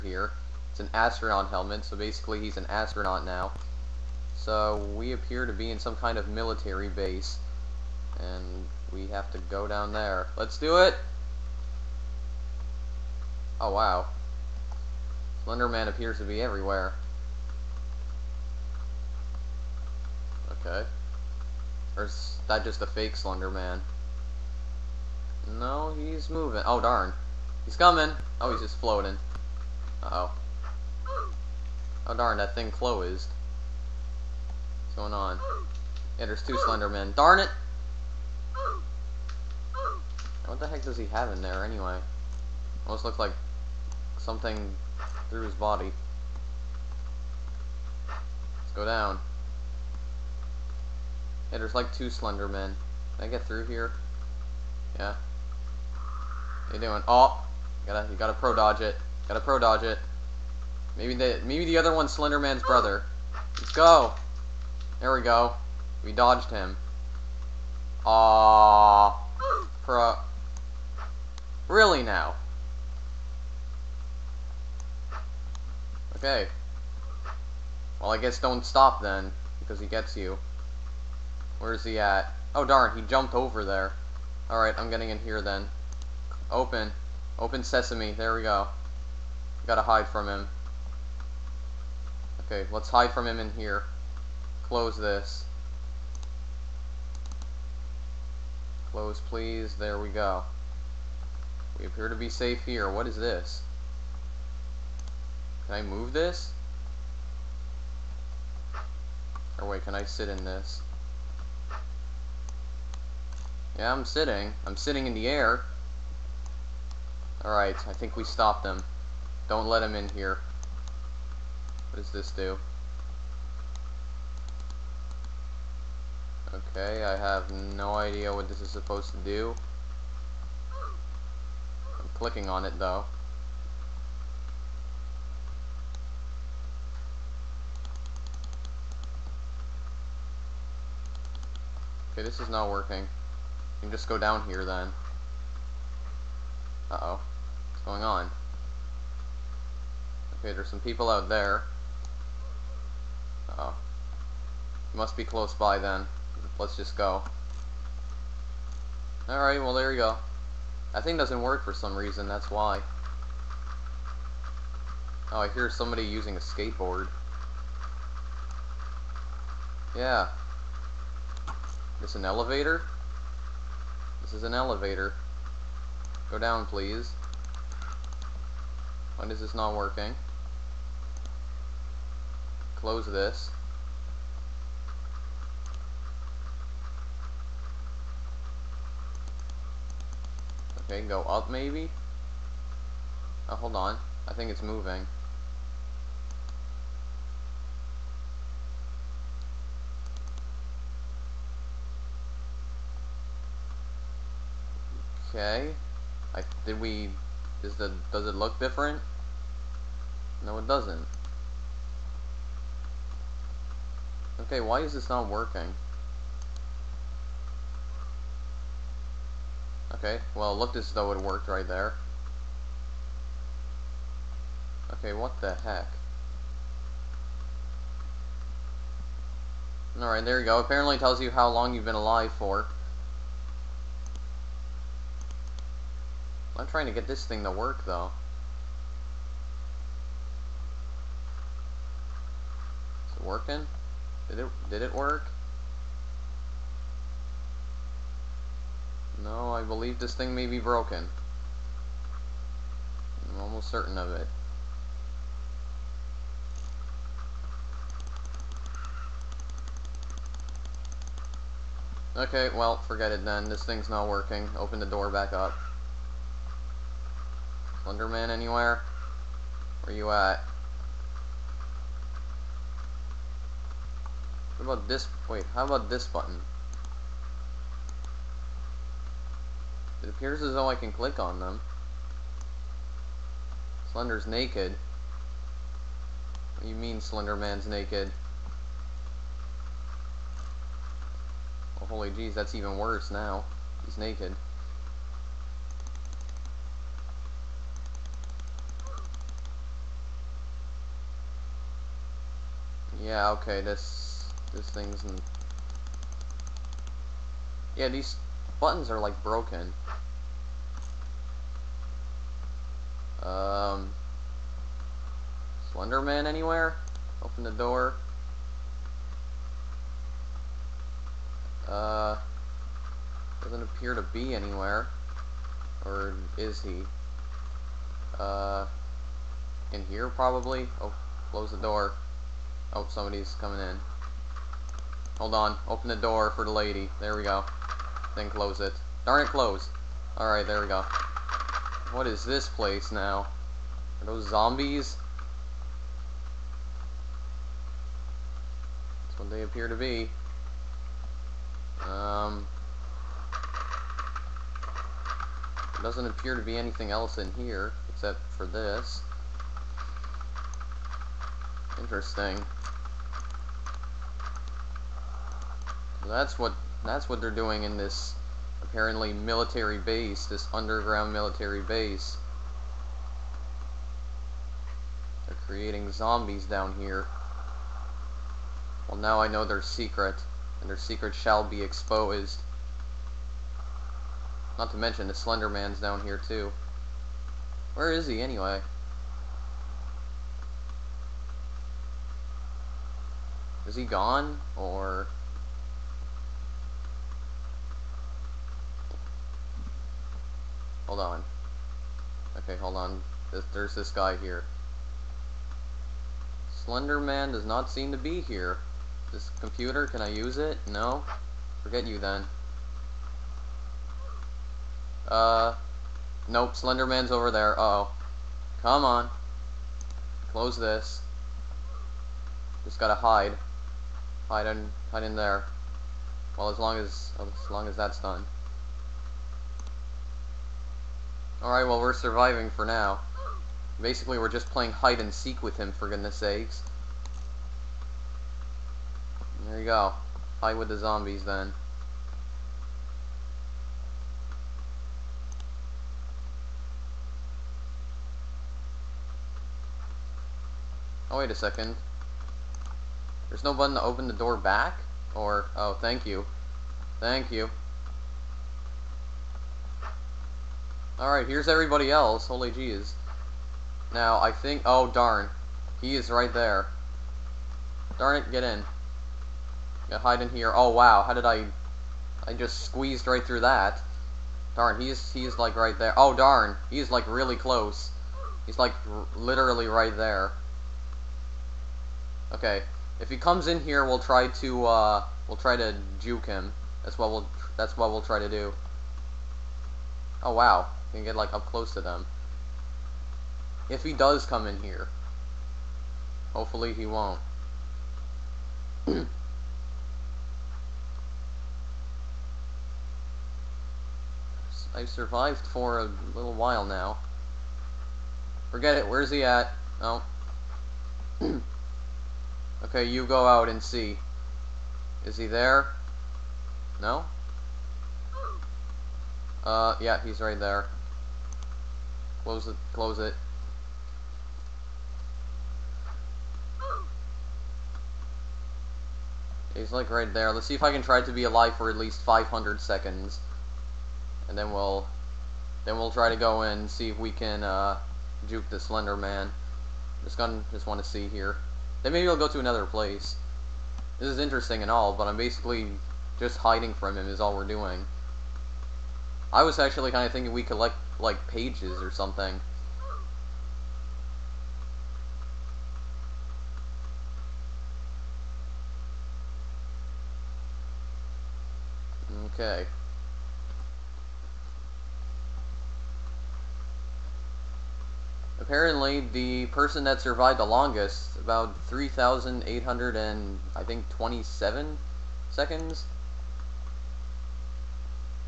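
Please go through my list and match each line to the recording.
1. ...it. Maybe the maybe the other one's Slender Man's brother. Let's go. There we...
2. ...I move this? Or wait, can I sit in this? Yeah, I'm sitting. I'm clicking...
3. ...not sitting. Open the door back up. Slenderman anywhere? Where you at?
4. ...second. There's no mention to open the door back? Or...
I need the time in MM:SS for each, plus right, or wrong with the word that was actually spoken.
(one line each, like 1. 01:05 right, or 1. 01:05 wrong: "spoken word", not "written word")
1. 00:59 right
2. 01:45 wrong: "sitting", not "clicking"
3. 04:23 wrong: "working", not "sitting"
4. 07:31 wrong: "button", not "mention".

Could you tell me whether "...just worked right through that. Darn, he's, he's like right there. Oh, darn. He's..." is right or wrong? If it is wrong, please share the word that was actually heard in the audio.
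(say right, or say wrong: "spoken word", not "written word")
wrong: "squeezed", not "worked".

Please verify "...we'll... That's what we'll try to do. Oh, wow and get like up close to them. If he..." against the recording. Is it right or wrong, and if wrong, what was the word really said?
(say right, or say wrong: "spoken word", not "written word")
right.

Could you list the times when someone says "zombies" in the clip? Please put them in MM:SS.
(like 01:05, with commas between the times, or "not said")
05:44, 06:15, 07:20.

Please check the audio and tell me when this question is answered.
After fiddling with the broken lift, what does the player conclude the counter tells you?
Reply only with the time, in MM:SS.
03:51.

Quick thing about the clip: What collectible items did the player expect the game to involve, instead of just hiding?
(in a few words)
pages.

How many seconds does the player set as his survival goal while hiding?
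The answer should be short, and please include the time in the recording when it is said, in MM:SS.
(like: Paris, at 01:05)
500, at 08:52.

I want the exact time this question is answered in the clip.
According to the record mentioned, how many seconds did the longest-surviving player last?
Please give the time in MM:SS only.
09:31.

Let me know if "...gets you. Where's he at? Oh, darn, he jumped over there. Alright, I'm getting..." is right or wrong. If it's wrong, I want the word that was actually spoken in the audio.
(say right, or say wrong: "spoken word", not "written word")
right.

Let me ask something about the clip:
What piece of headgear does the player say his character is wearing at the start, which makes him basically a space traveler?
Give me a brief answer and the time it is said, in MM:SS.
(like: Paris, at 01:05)
astronaut helmet, at 00:00.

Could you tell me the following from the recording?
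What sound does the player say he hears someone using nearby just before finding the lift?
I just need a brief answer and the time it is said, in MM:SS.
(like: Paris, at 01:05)
a skateboard, at 02:46.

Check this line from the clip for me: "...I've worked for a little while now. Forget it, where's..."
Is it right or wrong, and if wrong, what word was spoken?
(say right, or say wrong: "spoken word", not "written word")
wrong: "survived", not "worked".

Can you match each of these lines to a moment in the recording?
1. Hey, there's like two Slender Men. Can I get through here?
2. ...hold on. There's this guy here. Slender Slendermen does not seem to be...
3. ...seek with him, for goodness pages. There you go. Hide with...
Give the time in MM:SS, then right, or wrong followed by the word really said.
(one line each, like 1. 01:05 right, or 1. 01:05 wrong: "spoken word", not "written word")
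1. 00:51 right
2. 06:42 wrong: "Man", not "Slendermen"
3. 07:15 wrong: "sakes", not "pages".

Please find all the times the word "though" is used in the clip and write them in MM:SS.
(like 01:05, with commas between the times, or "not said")
02:12, 03:40, 03:57, 04:40.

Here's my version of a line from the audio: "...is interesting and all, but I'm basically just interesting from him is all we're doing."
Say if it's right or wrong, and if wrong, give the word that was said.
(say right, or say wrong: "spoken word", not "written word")
wrong: "hiding", not "interesting".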